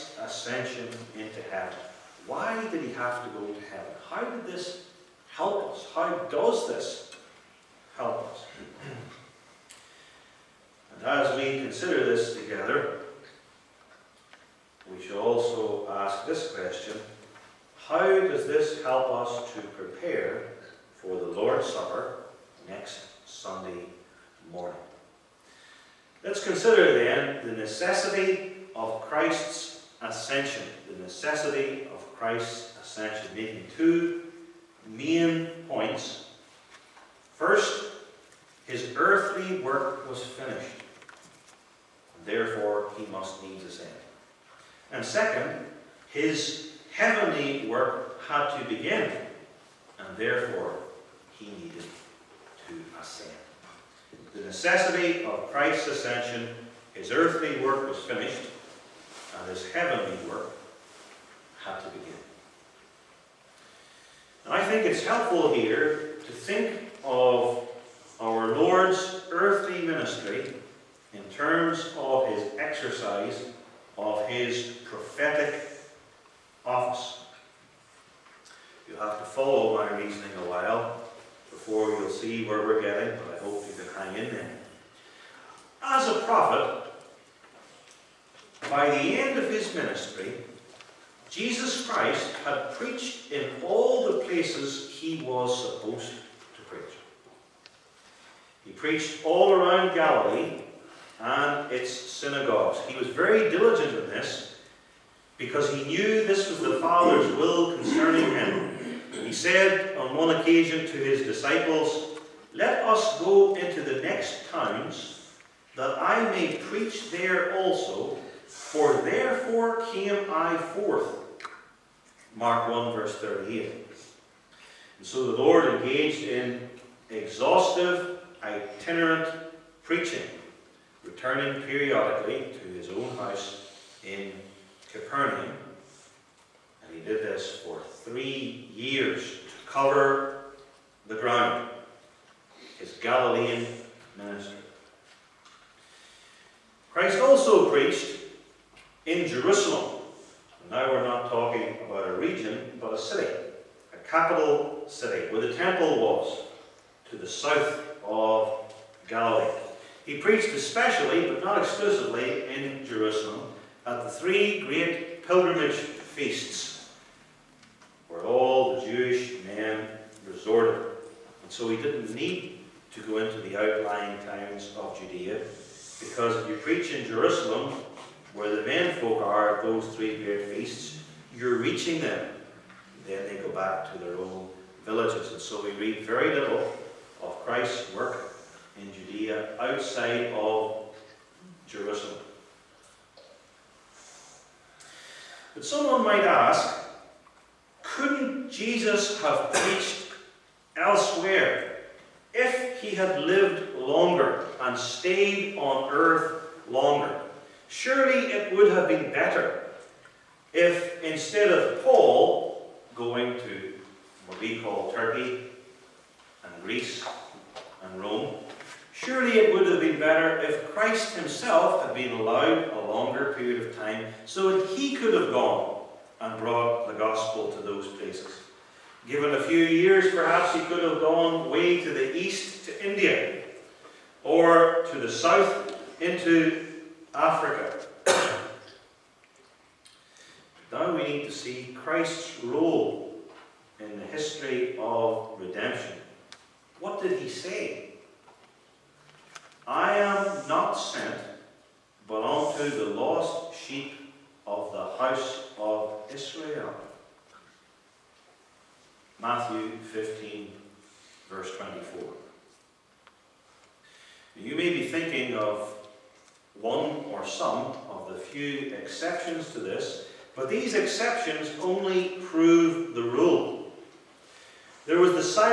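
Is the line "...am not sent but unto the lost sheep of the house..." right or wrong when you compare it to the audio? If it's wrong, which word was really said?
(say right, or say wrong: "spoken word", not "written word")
right.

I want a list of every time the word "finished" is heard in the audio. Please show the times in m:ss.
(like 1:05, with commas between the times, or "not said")
0:40, 0:57.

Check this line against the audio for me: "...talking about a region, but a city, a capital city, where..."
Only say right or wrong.
right.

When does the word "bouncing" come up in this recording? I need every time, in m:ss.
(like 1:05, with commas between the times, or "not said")
not said.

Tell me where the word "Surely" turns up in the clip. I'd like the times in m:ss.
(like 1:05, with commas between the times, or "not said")
3:27, 3:38.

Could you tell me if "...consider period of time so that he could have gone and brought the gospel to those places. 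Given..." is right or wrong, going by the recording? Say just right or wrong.
wrong.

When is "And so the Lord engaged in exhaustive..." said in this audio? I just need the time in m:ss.
2:04.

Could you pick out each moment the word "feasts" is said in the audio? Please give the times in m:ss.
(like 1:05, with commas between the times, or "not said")
2:45, 3:00.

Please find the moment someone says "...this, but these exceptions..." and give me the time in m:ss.
4:29.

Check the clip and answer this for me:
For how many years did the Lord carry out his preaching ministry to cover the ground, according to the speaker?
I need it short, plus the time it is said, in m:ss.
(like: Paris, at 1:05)
3, at 2:18.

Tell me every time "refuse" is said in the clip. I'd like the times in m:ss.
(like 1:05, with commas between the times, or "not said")
not said.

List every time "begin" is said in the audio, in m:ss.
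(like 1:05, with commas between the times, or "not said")
0:48, 1:01.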